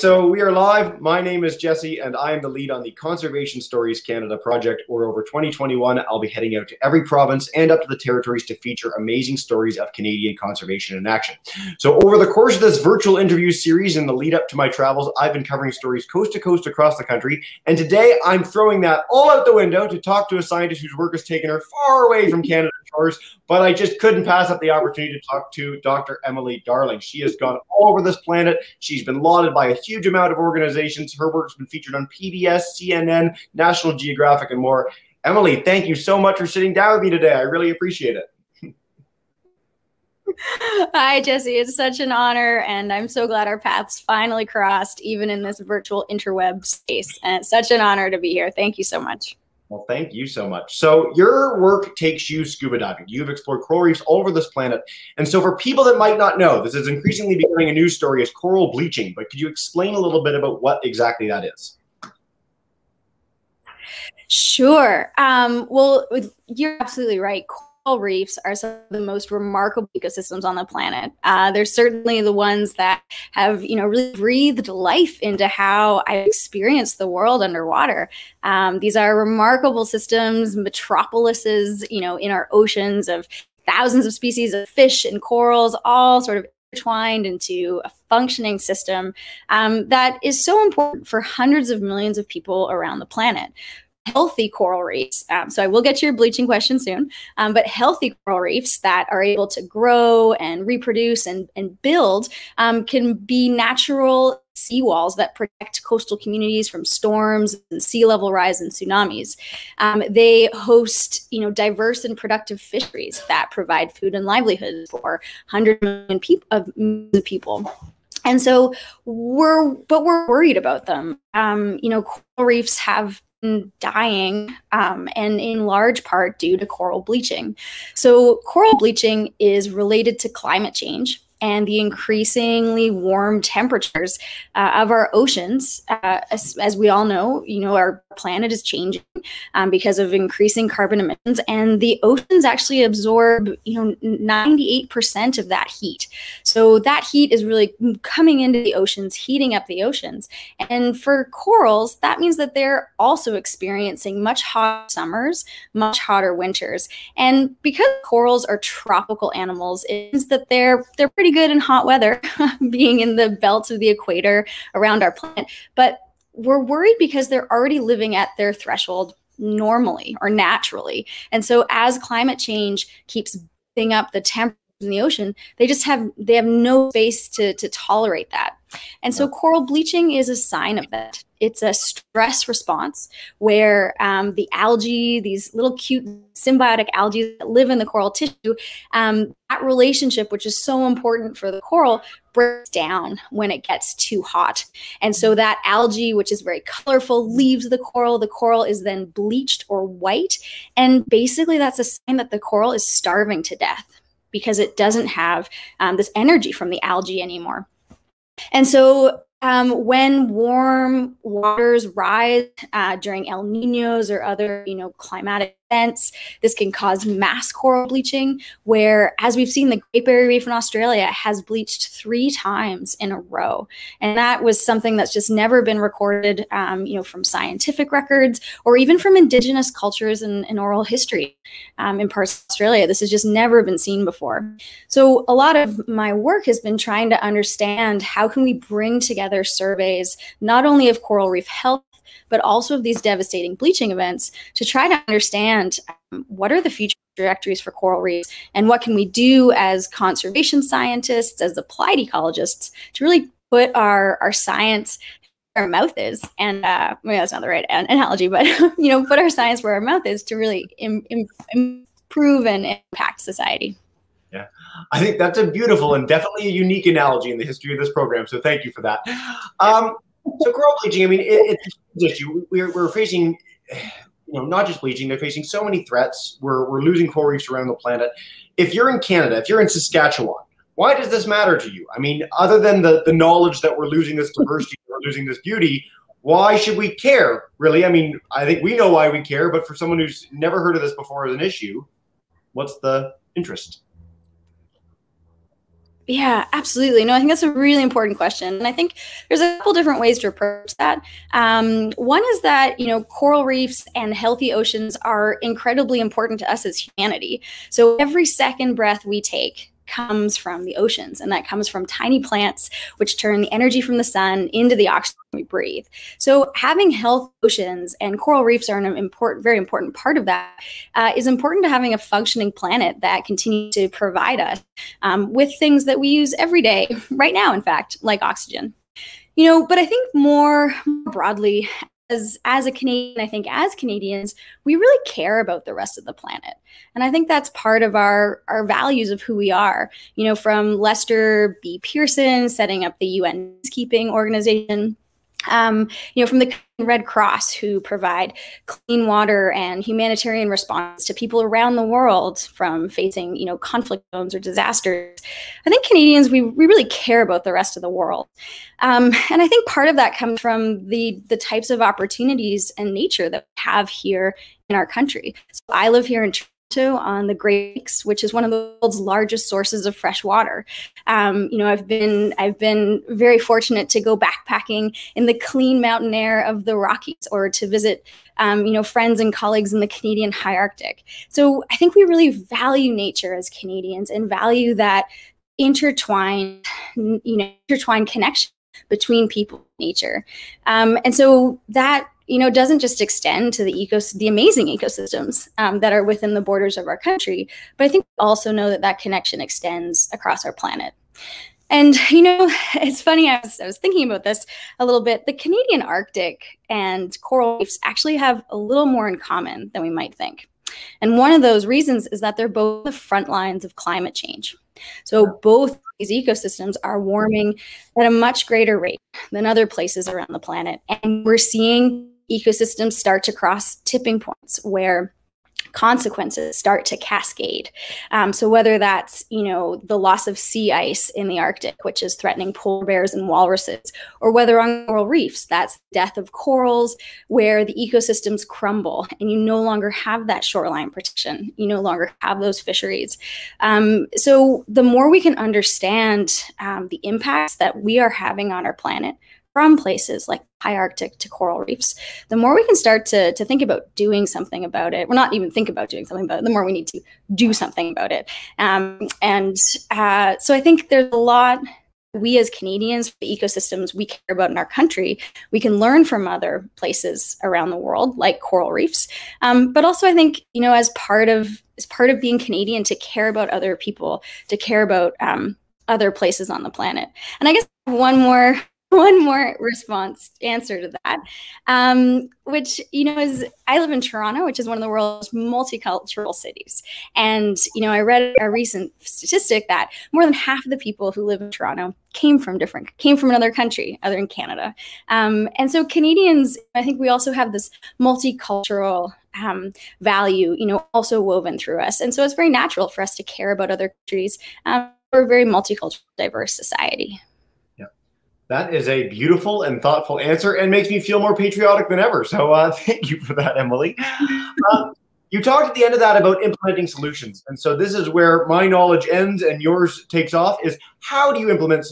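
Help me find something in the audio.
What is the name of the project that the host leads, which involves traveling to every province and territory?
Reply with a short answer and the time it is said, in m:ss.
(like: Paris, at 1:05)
Conservation Stories Canada, at 0:02.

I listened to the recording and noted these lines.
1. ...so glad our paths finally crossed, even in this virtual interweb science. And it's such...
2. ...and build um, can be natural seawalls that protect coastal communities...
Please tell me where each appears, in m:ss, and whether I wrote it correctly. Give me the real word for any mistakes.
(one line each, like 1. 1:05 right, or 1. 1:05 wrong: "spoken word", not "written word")
1. 0:43 wrong: "space", not "science"
2. 1:41 right.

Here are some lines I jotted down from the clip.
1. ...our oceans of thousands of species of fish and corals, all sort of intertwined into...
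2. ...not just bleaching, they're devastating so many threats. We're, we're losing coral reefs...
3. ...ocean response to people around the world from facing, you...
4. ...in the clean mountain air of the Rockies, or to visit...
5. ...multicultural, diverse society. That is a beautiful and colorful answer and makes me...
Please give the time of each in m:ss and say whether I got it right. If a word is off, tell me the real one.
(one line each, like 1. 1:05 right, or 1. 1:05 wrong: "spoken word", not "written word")
1. 1:22 right
2. 4:34 wrong: "facing", not "devastating"
3. 5:49 wrong: "humanitarian", not "ocean"
4. 6:15 right
5. 8:25 wrong: "thoughtful", not "colorful".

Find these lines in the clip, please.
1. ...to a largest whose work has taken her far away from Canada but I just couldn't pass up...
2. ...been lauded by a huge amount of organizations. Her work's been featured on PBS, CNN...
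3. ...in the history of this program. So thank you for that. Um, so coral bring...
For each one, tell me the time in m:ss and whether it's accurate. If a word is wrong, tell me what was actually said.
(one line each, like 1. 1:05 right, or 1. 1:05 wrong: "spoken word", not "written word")
1. 0:20 wrong: "scientist", not "largest"
2. 0:29 right
3. 4:27 wrong: "bleaching", not "bring".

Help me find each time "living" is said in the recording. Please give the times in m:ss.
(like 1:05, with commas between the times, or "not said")
2:47.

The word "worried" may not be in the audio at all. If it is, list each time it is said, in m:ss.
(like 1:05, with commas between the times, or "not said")
2:00, 2:46.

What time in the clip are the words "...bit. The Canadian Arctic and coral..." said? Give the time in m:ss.
6:45.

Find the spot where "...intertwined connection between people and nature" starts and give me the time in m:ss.
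6:27.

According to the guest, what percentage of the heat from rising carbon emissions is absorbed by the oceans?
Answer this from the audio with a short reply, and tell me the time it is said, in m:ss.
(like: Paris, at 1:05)
98%, at 2:24.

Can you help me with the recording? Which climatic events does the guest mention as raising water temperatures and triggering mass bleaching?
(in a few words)
El Ninos.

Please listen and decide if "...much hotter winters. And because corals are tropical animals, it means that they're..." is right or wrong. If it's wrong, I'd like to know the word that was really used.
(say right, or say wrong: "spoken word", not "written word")
right.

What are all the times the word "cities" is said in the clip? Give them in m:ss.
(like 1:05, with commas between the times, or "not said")
8:06.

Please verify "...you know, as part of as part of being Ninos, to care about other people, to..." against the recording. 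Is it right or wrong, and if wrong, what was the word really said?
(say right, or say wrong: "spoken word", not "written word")
wrong: "Canadian", not "Ninos".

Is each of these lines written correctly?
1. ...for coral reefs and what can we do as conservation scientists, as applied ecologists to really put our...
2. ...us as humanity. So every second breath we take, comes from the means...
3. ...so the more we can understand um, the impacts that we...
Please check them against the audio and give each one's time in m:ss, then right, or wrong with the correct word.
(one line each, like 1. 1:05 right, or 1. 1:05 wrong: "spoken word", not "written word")
1. 4:07 right
2. 5:06 wrong: "oceans", not "means"
3. 7:24 right.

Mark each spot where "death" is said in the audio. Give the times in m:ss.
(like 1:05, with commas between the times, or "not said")
3:23, 7:15.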